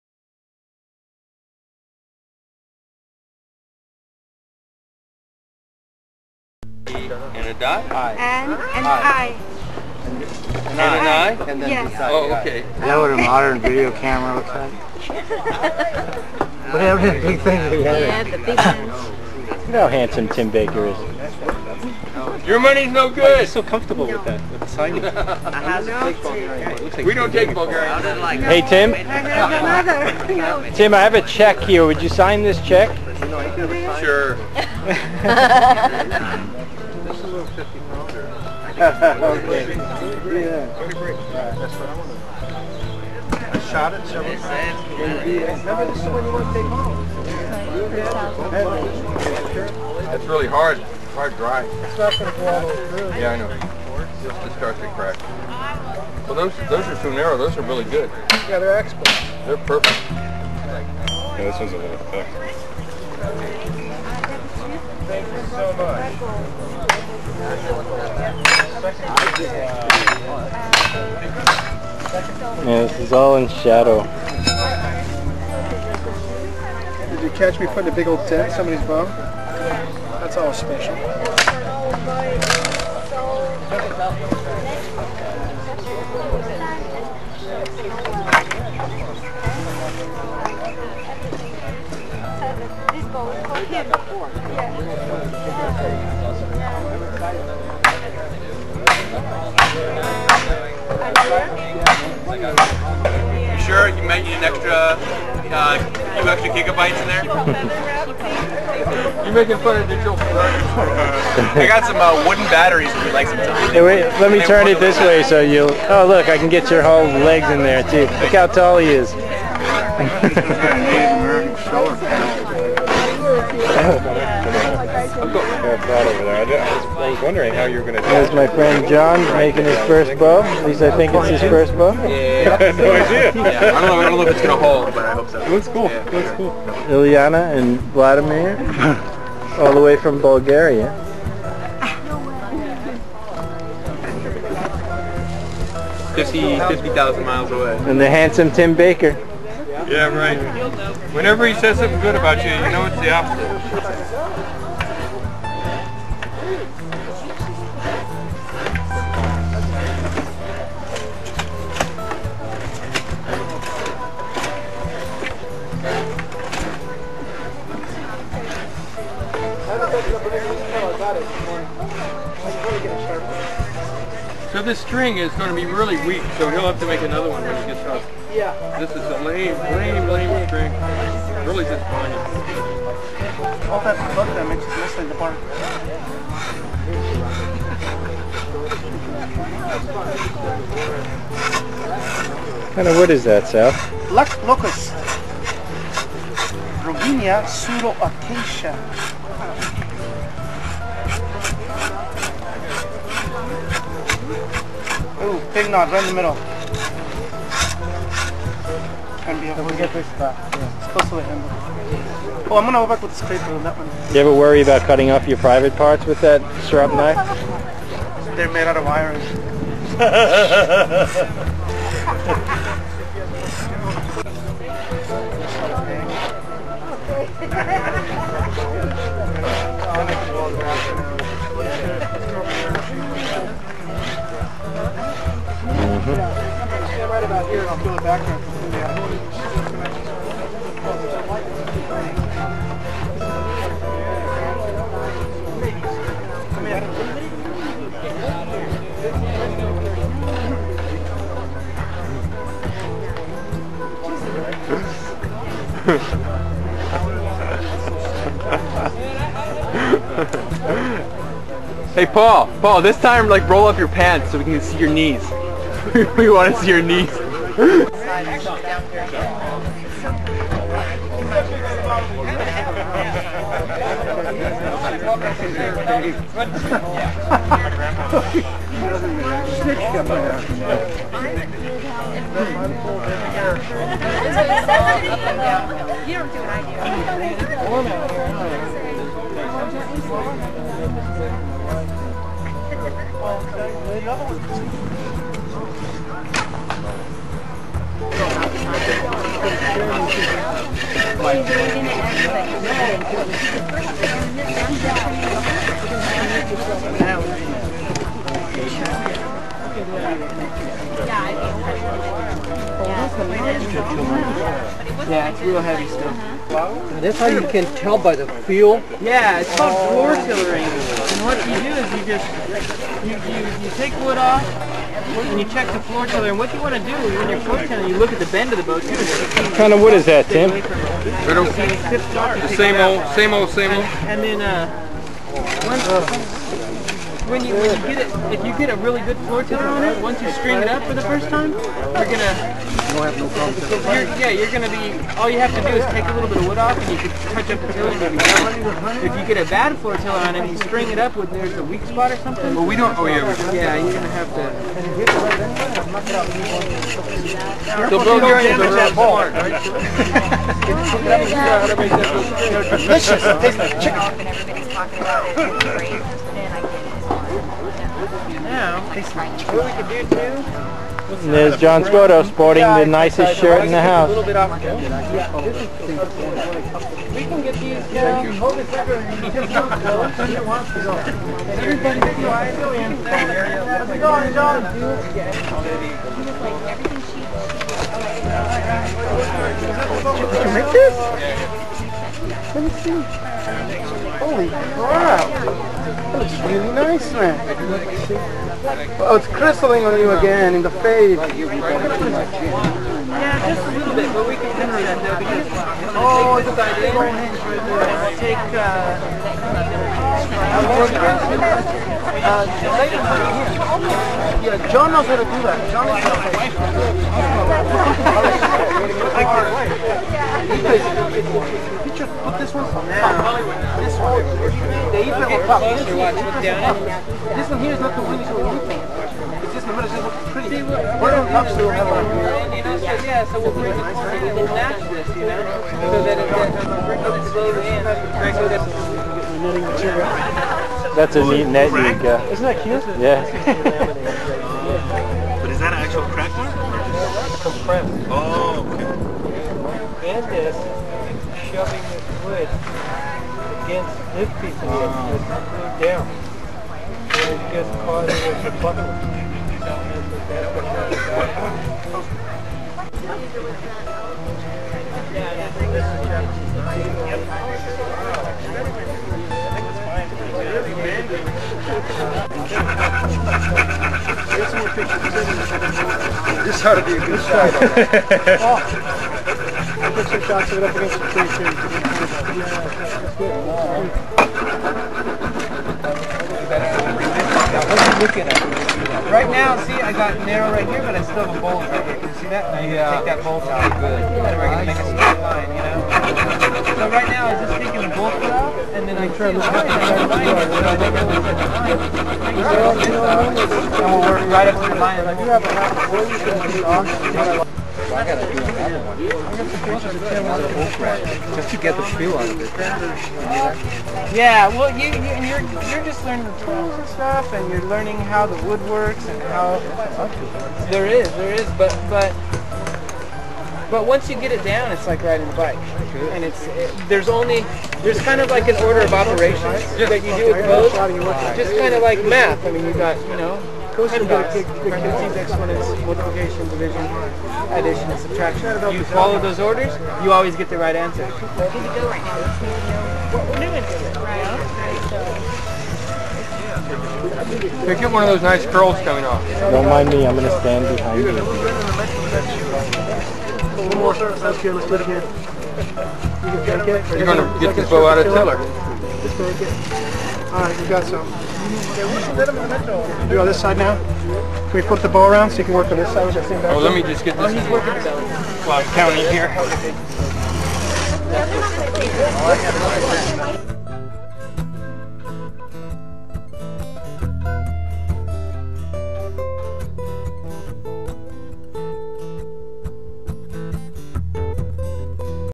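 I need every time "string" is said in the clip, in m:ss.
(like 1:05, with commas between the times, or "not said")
2:54, 5:40, 5:50.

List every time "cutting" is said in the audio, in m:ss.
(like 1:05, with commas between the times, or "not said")
3:34.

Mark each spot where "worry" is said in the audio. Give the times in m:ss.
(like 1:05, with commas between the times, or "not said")
3:34.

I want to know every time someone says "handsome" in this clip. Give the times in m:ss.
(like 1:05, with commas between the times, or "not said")
0:19, 2:28.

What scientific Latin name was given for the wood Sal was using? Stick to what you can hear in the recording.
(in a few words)
Robinia pseudoacacia.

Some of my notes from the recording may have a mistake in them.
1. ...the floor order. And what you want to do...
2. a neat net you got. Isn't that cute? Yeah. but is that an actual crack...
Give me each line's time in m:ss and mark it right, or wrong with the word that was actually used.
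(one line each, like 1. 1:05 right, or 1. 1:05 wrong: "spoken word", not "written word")
1. 5:25 wrong: "tiller", not "order"
2. 7:21 right.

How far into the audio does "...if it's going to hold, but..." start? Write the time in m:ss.
2:14.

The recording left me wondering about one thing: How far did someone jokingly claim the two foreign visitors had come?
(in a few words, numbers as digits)
50,000 miles.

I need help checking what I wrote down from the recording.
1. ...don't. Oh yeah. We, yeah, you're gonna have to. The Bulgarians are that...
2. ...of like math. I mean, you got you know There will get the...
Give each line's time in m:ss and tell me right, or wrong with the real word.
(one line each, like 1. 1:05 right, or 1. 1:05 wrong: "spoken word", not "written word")
1. 5:52 right
2. 8:51 wrong: "Coast", not "There".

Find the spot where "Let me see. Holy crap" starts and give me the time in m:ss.
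6:32.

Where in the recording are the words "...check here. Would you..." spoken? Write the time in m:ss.
0:31.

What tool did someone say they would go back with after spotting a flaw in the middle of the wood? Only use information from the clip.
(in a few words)
scraper.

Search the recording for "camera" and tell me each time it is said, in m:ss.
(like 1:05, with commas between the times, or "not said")
0:13.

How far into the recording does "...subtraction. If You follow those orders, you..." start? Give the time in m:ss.
8:58.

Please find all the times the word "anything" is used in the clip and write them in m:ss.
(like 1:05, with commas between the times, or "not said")
7:08.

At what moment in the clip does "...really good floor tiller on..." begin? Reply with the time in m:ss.
5:38.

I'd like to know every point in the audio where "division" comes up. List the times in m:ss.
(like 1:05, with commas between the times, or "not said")
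8:56.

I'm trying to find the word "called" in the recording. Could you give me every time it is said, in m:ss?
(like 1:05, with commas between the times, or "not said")
5:19.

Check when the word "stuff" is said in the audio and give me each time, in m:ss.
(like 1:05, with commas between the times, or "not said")
5:15, 8:36.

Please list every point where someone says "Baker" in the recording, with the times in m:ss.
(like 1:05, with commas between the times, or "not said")
0:20, 2:28.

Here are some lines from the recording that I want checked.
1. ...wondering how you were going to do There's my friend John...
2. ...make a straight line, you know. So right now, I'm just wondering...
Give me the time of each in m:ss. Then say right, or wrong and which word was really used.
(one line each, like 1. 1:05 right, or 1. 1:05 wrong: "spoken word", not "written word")
1. 2:07 right
2. 8:14 wrong: "taking", not "wondering".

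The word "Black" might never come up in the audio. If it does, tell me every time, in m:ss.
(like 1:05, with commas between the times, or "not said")
3:14.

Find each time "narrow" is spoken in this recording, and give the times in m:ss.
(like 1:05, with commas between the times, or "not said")
0:57, 8:10.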